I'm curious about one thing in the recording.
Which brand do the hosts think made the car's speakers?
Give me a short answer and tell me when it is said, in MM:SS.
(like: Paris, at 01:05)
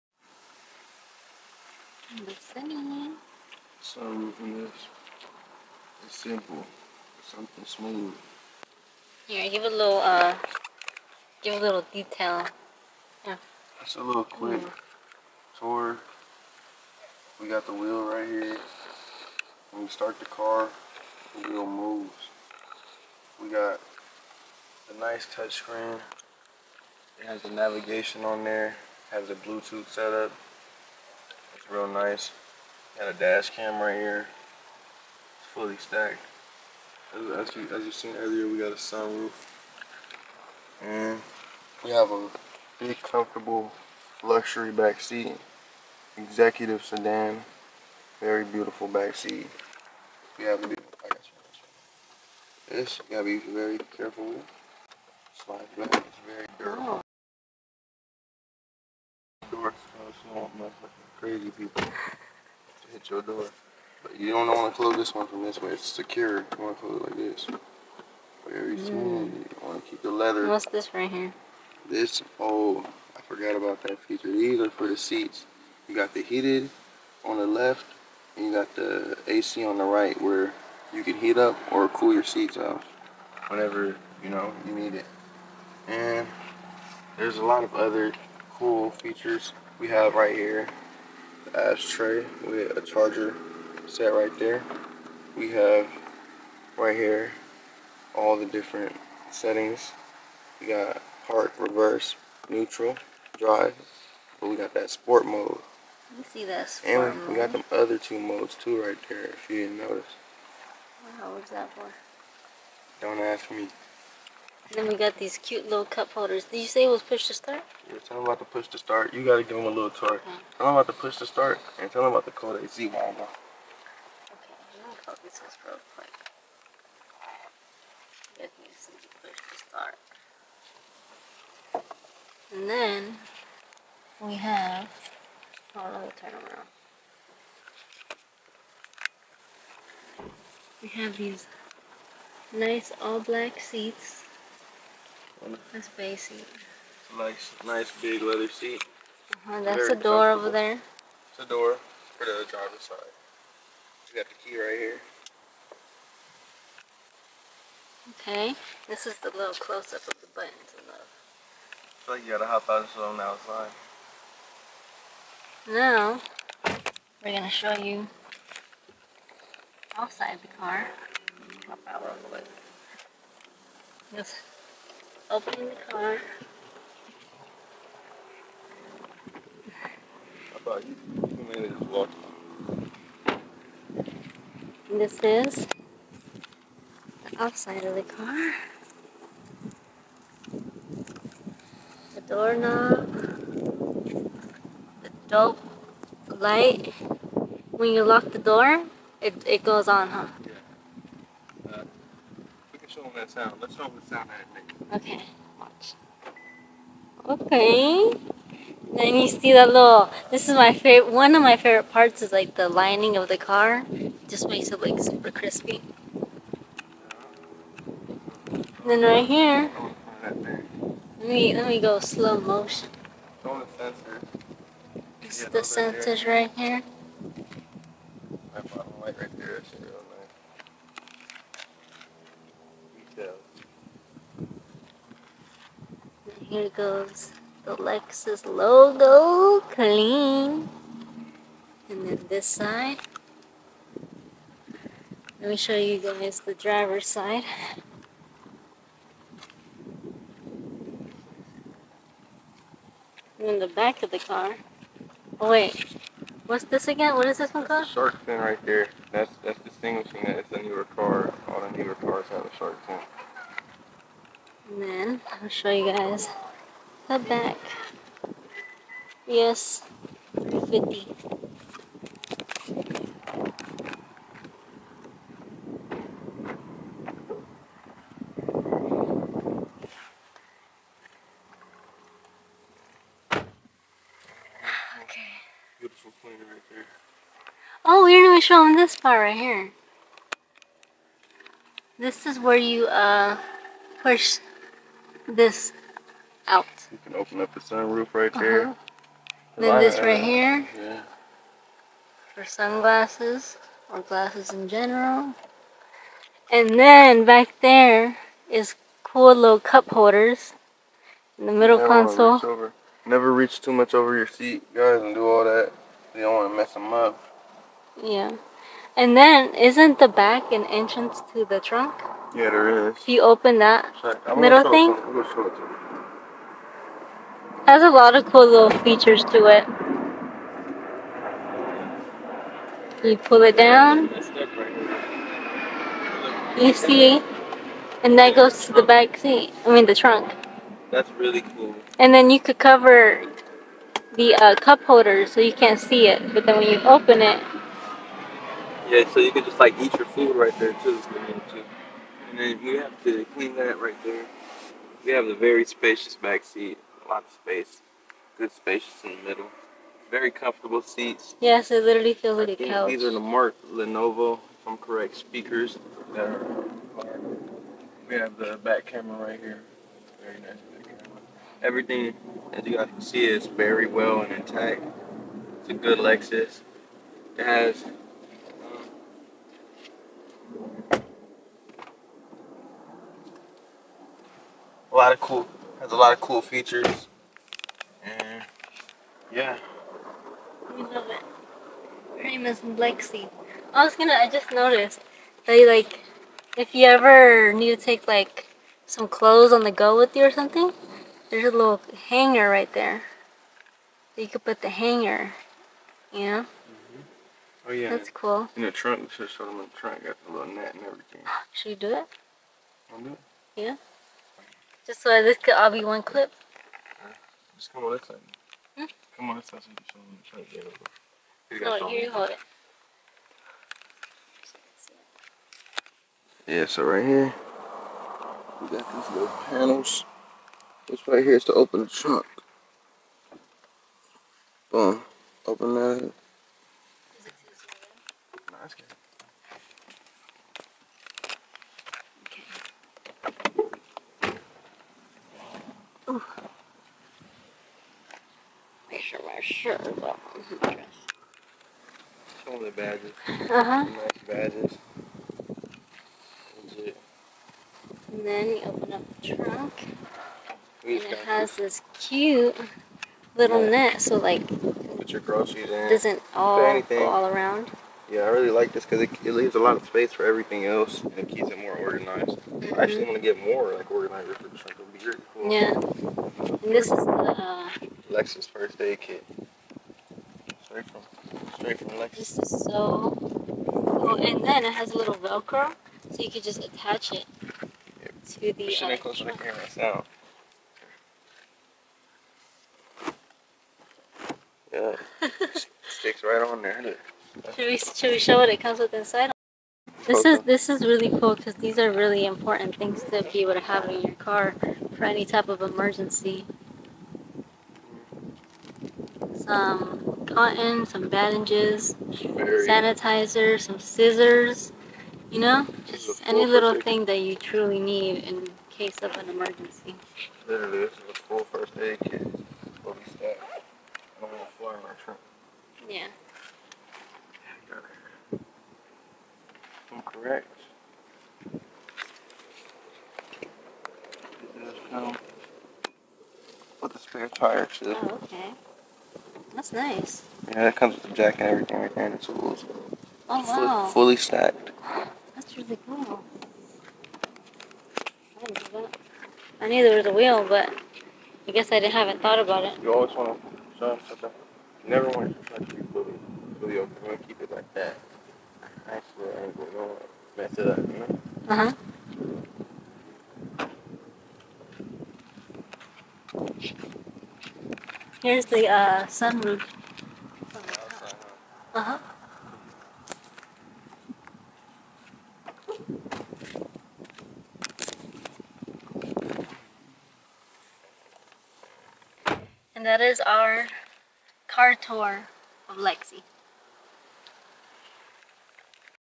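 Mark Levinson, at 06:03.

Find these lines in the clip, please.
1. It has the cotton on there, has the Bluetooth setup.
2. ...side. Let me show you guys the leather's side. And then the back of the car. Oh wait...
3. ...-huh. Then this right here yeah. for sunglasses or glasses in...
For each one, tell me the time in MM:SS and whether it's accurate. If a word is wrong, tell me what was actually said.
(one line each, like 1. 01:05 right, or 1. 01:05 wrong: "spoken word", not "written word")
1. 00:27 wrong: "navigation", not "cotton"
2. 04:02 wrong: "driver", not "leather"
3. 04:58 right.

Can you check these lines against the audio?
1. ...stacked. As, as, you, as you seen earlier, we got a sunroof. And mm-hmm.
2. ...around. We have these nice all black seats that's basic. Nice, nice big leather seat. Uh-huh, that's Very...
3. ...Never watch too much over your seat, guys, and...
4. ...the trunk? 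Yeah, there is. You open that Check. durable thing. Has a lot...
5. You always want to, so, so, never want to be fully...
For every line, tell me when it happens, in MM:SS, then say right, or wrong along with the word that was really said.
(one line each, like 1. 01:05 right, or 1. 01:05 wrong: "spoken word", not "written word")
1. 00:35 right
2. 02:16 right
3. 05:13 wrong: "reach", not "watch"
4. 05:21 wrong: "middle", not "durable"
5. 09:12 right.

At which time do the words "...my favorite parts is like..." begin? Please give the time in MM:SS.
03:31.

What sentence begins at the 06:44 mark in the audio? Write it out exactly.
You could put the hanger, you know?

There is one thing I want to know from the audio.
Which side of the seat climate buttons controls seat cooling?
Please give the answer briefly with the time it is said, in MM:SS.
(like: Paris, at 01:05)
The right, at 01:19.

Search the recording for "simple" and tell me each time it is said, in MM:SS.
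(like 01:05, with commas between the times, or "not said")
00:06.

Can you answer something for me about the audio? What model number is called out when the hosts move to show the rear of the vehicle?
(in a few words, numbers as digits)
350.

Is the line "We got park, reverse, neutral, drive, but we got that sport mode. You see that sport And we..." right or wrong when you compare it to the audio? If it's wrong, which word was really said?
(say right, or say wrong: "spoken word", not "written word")
right.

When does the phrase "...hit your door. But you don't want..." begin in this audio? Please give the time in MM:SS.
01:02.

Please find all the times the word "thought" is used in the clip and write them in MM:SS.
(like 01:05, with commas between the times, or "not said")
09:12.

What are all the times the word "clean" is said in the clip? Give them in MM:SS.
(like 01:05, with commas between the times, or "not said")
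03:59, 05:53.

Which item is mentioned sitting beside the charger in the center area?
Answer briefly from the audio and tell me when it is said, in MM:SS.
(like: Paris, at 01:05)
Ashtray, at 01:31.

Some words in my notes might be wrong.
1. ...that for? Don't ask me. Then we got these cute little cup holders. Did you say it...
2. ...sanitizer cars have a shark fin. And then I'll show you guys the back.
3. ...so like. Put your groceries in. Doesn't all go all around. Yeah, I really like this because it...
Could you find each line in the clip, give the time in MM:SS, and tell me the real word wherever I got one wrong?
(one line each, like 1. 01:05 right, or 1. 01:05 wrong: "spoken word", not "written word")
1. 01:51 right
2. 04:21 wrong: "newer", not "sanitizer"
3. 07:44 right.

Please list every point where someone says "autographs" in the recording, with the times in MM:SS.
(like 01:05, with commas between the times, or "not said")
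not said.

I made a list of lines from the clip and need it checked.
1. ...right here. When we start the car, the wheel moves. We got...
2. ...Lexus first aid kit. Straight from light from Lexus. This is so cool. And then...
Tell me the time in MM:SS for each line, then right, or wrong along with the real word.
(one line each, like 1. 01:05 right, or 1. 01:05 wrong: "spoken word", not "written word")
1. 00:18 right
2. 07:58 wrong: "straight", not "light".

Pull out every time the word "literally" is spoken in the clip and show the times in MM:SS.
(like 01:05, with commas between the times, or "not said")
06:01, 08:40.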